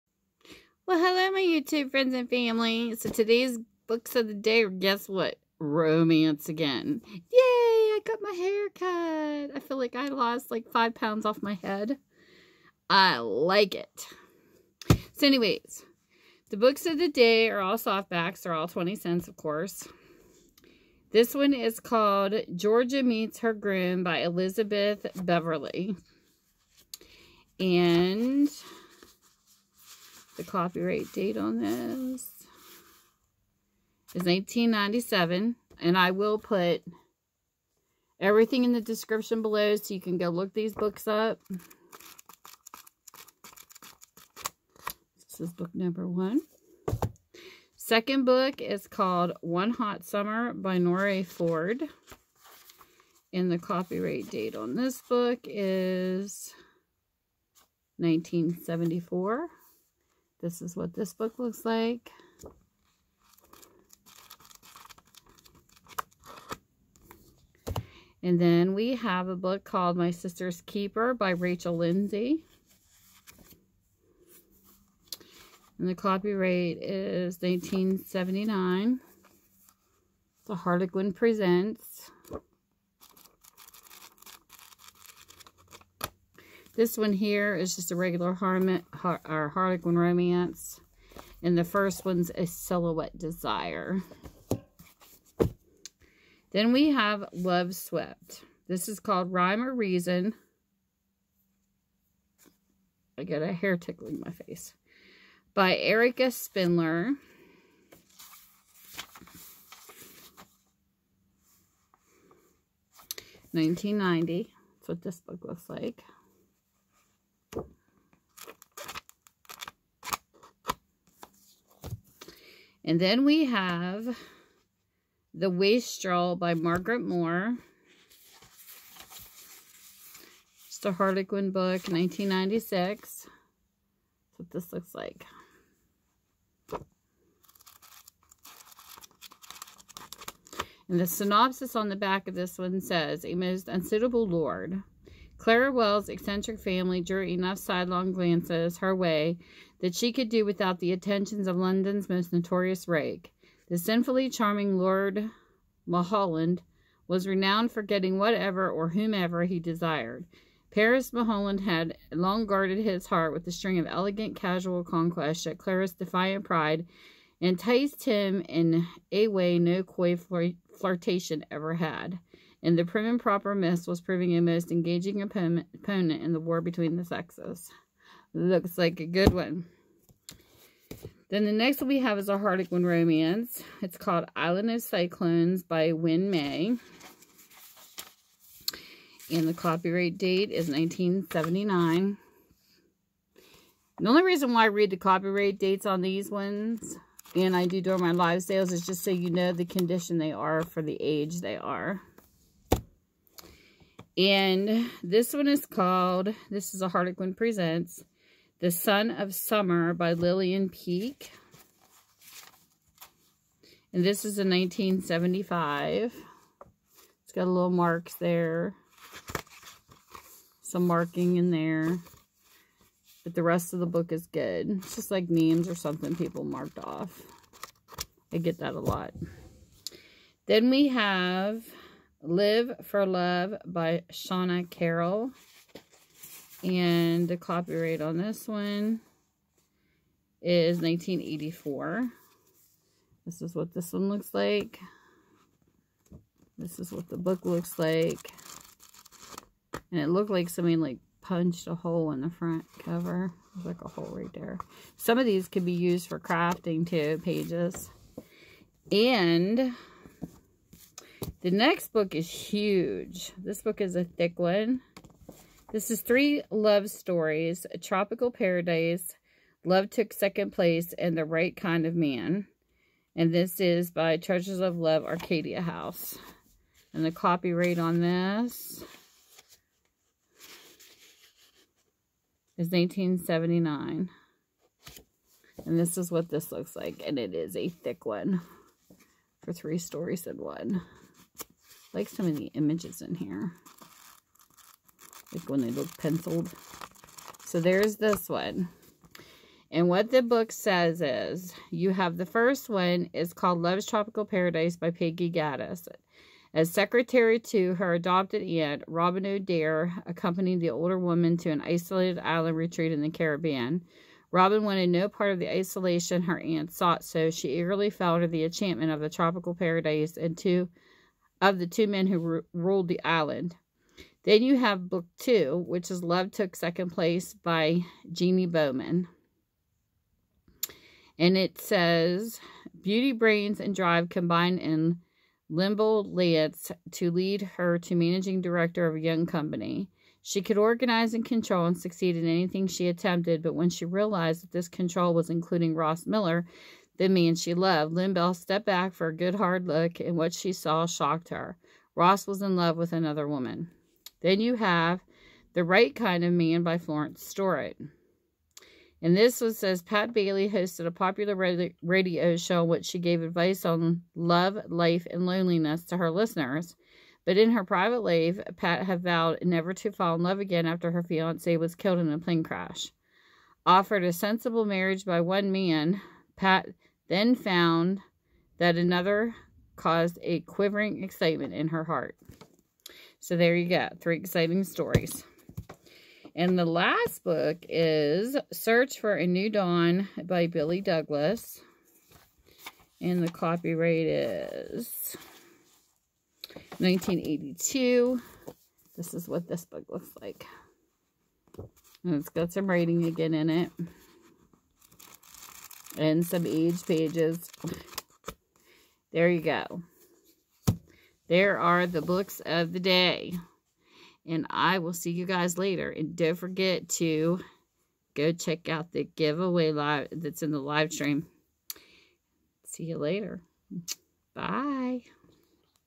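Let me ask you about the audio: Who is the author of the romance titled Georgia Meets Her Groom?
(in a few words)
Elizabeth Bevarly.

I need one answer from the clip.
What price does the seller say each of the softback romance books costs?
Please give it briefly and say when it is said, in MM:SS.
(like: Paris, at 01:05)
20 cents, at 00:18.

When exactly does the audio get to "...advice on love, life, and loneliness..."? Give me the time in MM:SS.
06:03.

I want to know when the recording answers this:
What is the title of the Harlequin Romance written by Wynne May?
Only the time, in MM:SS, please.
03:04.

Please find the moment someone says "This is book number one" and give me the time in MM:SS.
00:45.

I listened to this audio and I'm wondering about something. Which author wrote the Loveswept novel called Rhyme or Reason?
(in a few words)
Erica Spindler.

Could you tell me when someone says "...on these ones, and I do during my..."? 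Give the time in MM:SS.
03:15.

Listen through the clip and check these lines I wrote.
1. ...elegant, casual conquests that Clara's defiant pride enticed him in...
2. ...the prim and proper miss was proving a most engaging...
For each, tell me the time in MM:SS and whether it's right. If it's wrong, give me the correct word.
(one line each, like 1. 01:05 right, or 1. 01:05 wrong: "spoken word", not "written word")
1. 02:43 right
2. 02:52 right.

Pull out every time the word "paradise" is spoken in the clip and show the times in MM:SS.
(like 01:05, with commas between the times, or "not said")
04:28, 05:04, 05:19.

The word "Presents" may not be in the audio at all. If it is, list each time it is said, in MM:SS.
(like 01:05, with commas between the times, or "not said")
01:21, 03:27.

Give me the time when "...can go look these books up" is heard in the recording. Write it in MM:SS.
00:40.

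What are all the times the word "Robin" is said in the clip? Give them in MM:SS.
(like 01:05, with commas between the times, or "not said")
05:08, 05:14.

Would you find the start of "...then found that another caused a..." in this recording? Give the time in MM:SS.
06:17.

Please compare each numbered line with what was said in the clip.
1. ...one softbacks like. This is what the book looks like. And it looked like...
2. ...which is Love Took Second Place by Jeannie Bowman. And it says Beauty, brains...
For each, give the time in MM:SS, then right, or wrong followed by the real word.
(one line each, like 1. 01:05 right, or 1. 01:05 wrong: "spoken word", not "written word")
1. 04:03 wrong: "looks", not "softbacks"
2. 05:25 right.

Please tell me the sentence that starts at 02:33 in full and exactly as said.
The sinfully charming Lord Mulholland was renowned for getting whatever or whomever he desired.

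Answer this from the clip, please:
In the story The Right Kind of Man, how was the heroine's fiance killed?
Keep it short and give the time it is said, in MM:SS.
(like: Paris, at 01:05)
Plane crash, at 06:12.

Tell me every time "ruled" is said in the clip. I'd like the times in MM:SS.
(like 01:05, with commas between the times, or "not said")
05:22.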